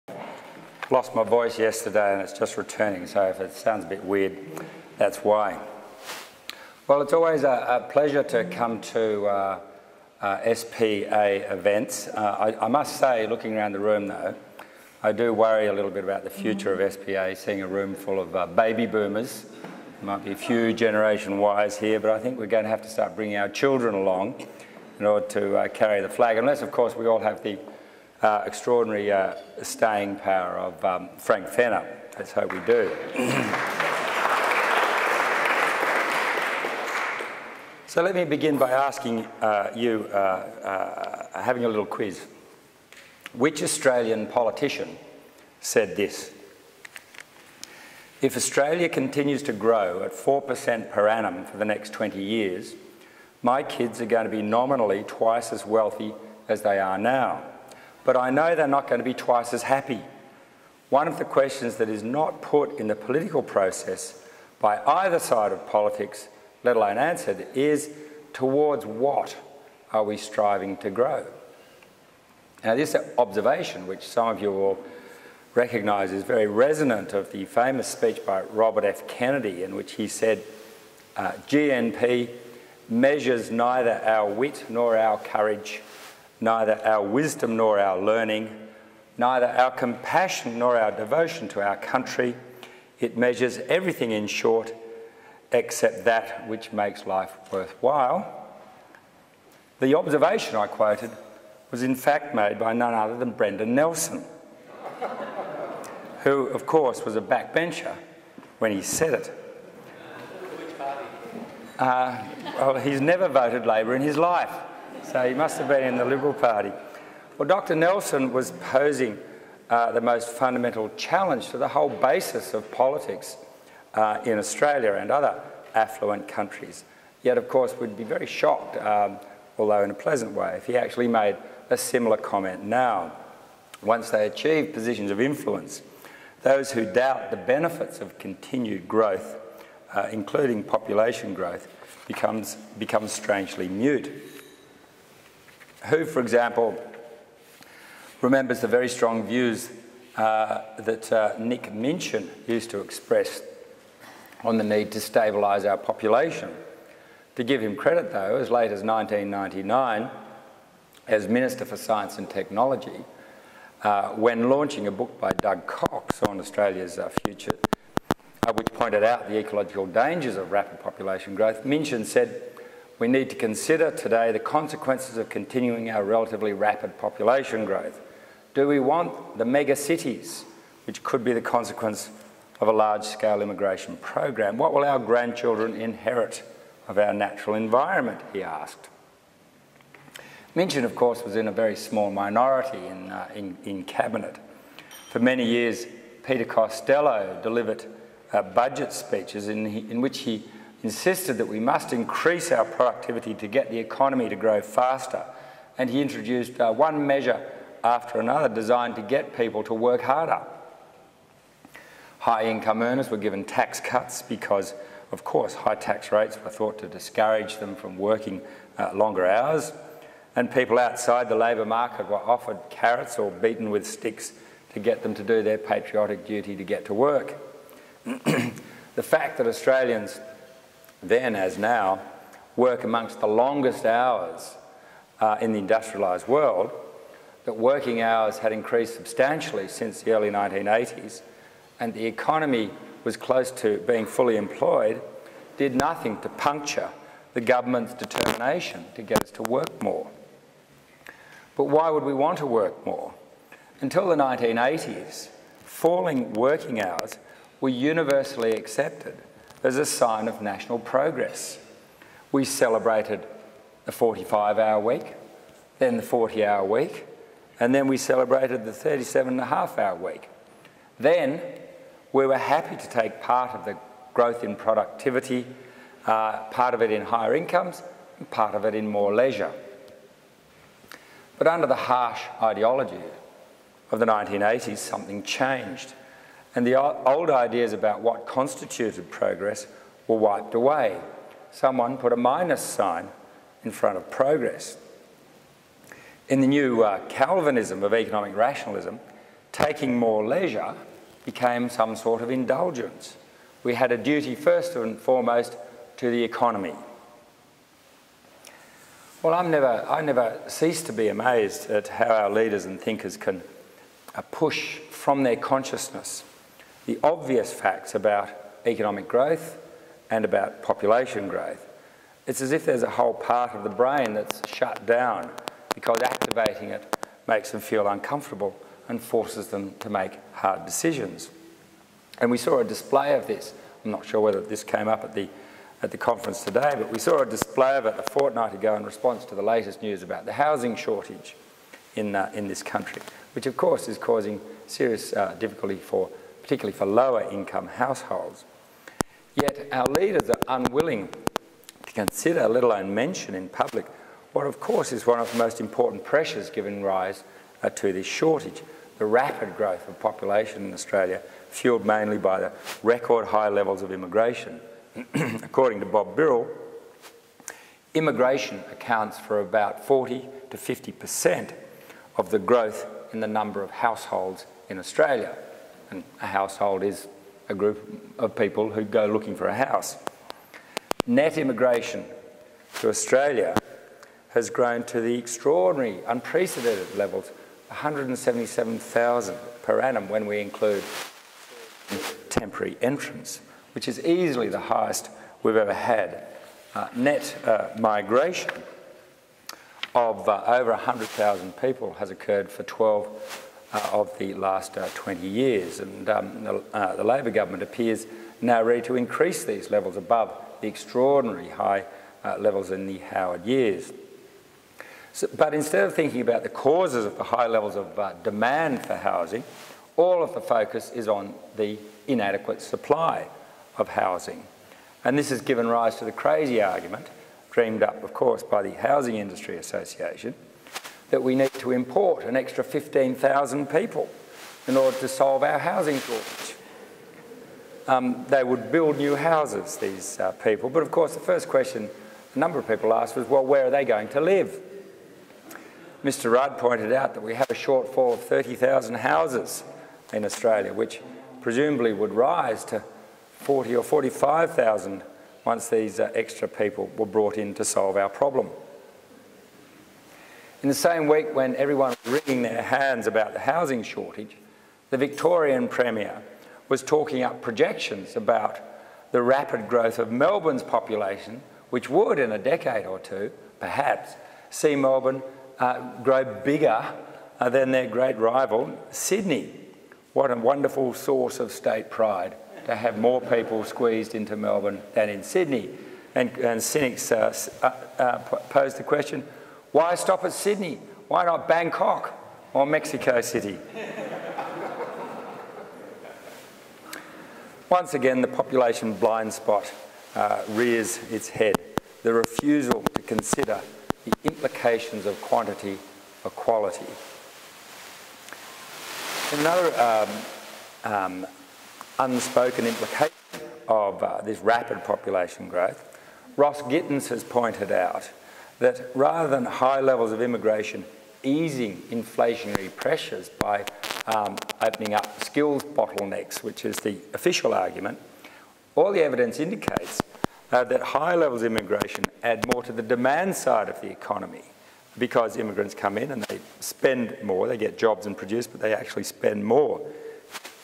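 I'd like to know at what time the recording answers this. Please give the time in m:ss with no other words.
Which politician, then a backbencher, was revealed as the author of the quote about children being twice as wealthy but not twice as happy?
1:43.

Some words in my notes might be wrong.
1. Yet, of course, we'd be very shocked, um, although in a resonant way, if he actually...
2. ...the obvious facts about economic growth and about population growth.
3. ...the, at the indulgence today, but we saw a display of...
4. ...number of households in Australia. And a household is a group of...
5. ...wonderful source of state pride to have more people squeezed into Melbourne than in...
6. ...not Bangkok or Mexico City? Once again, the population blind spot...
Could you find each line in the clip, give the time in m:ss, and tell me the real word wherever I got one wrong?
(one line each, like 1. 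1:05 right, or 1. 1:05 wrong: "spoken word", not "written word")
1. 2:07 wrong: "pleasant", not "resonant"
2. 5:16 right
3. 5:35 wrong: "conference", not "indulgence"
4. 6:13 right
5. 8:00 right
6. 8:11 right.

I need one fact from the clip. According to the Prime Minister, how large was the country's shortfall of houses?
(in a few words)
30,000.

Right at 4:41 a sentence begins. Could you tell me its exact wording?
But under the harsh ideology of the 1980s, something changed and the old ideas about what constituted progress were wiped away.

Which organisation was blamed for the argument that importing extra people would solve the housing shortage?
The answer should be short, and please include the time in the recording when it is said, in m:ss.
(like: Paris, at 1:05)
Housing Industry Association, at 7:08.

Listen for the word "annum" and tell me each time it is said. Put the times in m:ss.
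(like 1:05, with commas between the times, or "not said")
0:51, 6:29.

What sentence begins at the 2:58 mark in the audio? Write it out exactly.
Do we want the mega cities, which could be the consequence of a large-scale immigration program?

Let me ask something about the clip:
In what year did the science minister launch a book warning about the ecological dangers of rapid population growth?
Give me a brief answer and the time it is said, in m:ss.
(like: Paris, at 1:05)
1999, at 2:38.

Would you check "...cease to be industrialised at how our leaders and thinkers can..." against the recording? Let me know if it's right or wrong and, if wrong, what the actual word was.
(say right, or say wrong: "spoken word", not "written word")
wrong: "amazed", not "industrialised".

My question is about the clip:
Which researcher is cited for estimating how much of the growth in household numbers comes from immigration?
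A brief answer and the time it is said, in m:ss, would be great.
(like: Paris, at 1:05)
Bob Birrell, at 6:05.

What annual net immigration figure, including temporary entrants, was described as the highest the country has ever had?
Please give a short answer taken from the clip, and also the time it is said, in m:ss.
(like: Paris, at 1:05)
177,000, at 6:27.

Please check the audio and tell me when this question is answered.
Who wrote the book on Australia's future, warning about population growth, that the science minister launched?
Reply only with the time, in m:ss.
2:45.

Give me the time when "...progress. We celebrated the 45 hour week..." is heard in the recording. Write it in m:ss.
4:20.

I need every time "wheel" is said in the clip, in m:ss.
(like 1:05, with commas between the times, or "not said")
not said.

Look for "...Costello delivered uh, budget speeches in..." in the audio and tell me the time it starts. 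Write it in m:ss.
3:16.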